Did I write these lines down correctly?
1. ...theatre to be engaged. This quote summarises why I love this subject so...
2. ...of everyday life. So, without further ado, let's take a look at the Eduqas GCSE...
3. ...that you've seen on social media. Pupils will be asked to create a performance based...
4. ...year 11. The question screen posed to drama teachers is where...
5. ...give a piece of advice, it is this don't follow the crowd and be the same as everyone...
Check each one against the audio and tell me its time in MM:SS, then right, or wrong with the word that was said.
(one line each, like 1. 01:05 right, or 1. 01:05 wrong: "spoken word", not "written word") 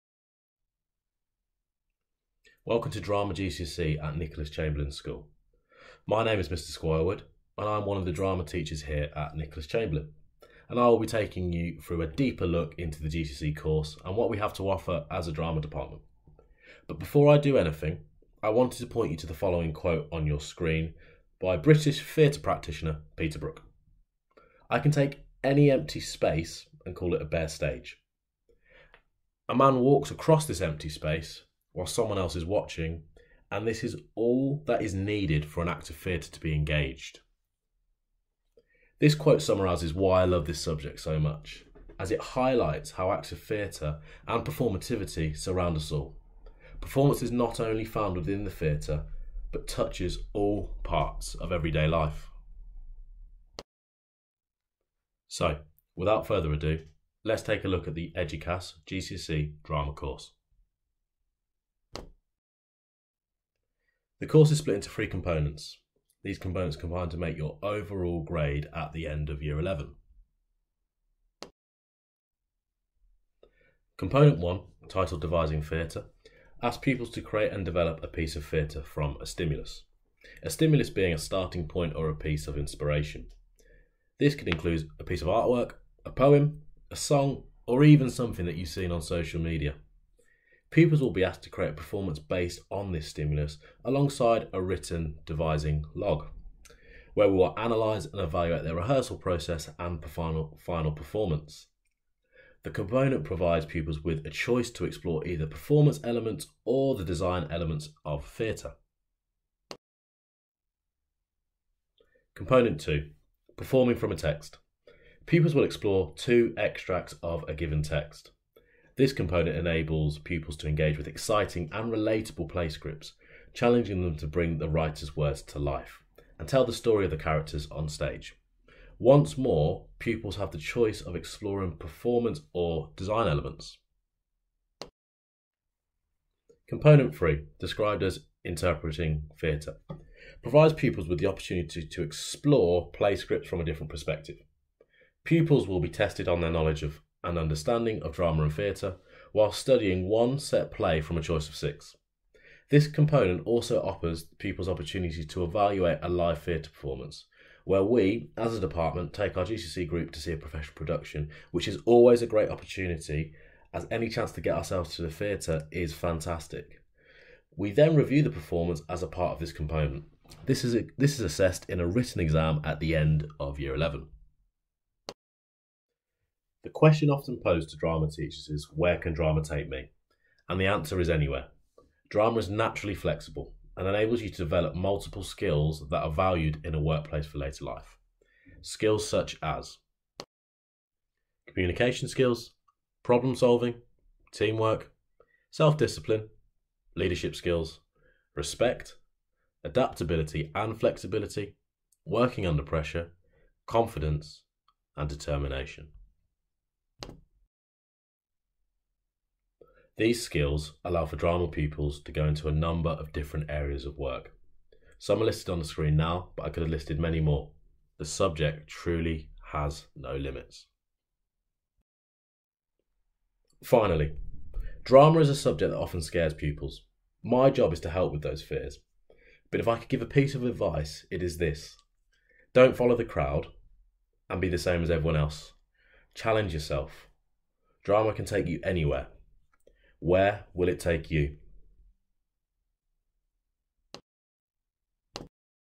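1. 00:35 right
2. 00:51 right
3. 01:28 right
4. 02:53 wrong: "often", not "screen"
5. 03:49 right.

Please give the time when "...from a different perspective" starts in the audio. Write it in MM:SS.
02:23.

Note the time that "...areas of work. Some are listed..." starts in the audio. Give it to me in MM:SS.
03:33.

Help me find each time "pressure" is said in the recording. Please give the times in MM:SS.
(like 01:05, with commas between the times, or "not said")
03:22.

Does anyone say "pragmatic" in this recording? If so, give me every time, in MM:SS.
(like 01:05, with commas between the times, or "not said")
not said.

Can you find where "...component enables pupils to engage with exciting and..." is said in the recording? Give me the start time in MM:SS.
01:59.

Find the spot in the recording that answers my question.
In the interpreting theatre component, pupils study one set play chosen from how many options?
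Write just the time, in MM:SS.
02:31.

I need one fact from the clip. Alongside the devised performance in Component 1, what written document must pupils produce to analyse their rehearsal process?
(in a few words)
Devising log.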